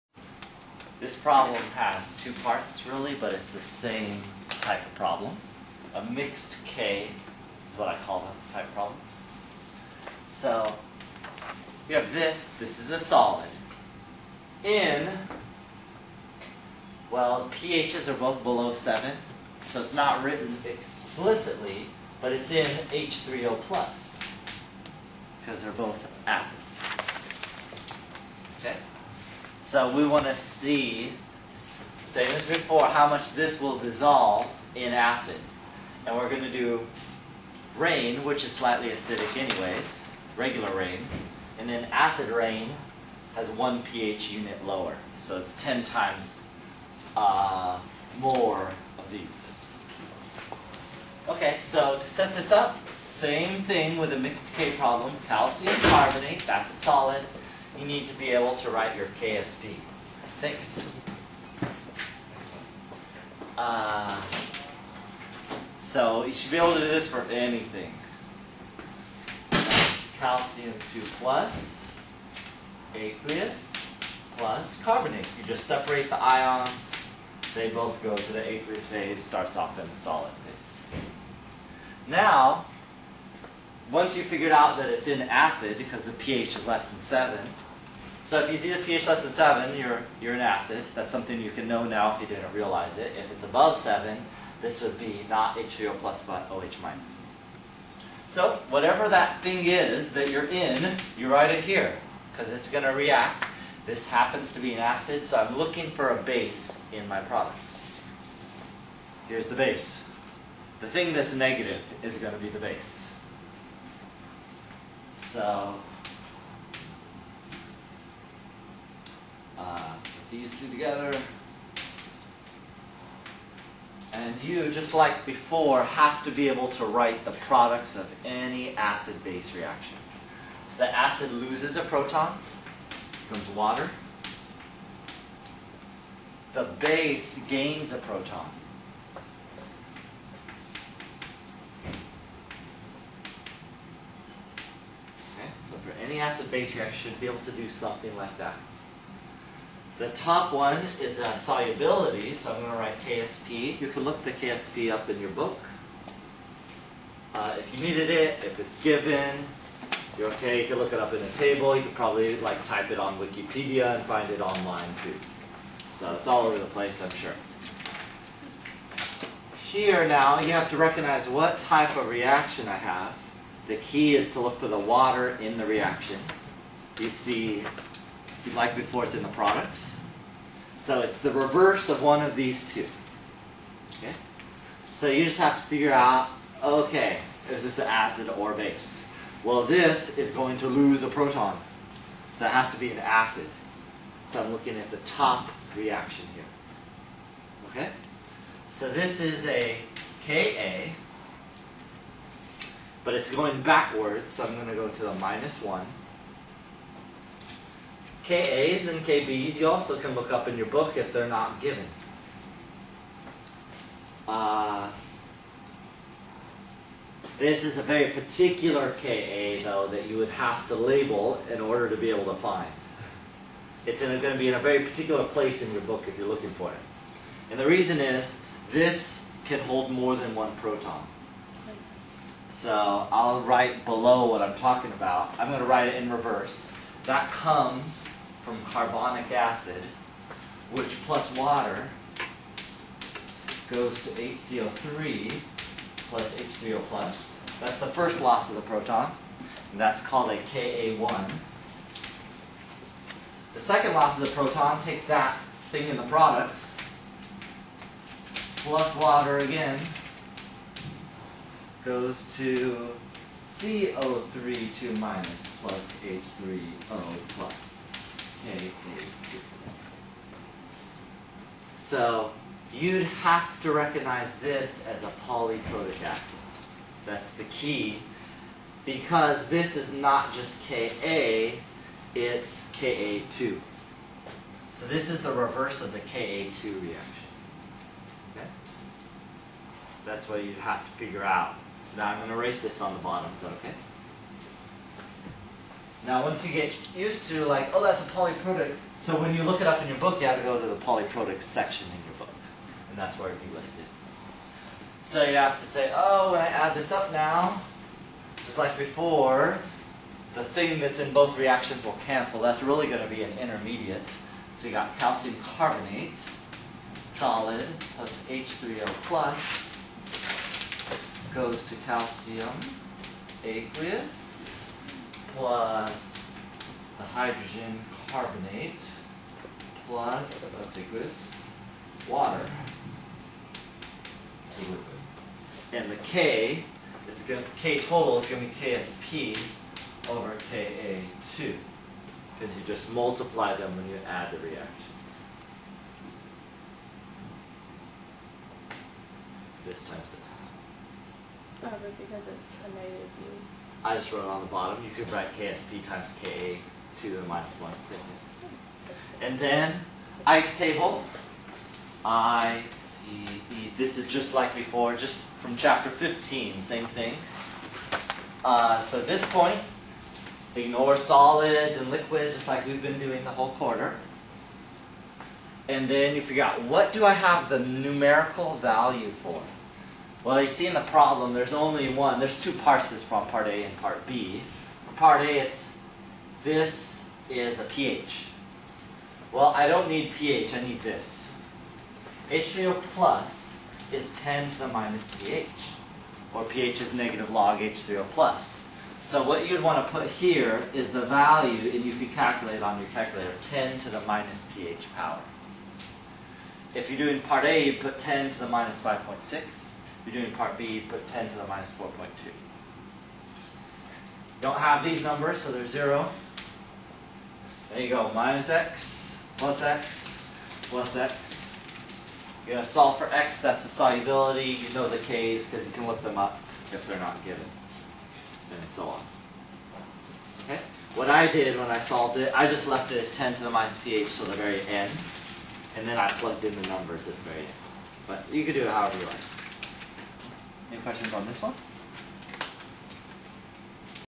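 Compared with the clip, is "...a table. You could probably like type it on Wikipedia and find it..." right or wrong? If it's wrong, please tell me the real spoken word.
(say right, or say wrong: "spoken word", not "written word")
right.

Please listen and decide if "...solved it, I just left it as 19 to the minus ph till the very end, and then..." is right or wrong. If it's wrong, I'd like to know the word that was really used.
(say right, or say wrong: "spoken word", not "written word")
wrong: "10", not "19".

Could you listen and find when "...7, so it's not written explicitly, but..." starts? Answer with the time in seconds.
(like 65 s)
18 s.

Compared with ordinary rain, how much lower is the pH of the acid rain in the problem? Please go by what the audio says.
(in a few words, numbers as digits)
one pH unit.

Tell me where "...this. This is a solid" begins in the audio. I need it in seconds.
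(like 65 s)
12 s.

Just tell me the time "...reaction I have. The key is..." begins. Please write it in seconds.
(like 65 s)
172 s.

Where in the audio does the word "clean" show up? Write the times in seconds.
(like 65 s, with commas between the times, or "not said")
not said.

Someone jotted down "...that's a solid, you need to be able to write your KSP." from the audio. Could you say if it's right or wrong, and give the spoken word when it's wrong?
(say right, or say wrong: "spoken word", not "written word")
right.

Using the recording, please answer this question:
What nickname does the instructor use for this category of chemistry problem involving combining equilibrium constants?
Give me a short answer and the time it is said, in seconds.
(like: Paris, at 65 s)
mixed K, at 5 s.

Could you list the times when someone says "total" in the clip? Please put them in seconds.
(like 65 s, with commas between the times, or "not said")
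337 s.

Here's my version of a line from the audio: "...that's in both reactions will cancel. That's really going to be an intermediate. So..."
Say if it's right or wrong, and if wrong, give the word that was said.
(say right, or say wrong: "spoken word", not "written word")
right.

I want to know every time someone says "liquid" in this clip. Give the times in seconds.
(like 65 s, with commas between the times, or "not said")
334 s, 371 s.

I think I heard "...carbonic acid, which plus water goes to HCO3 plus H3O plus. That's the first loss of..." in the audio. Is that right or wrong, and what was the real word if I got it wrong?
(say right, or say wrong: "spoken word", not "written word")
right.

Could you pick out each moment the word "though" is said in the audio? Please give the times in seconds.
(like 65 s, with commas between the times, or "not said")
219 s.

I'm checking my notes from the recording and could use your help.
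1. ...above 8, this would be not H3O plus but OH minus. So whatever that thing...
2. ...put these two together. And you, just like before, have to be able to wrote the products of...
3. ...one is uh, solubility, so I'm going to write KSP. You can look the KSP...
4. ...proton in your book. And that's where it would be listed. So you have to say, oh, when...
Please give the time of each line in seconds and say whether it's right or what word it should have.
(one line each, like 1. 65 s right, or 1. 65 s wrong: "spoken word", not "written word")
1. 93 s wrong: "7", not "8"
2. 120 s wrong: "write", not "wrote"
3. 150 s right
4. 301 s wrong: "section", not "proton".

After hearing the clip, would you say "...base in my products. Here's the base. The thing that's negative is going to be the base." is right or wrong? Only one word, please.
right.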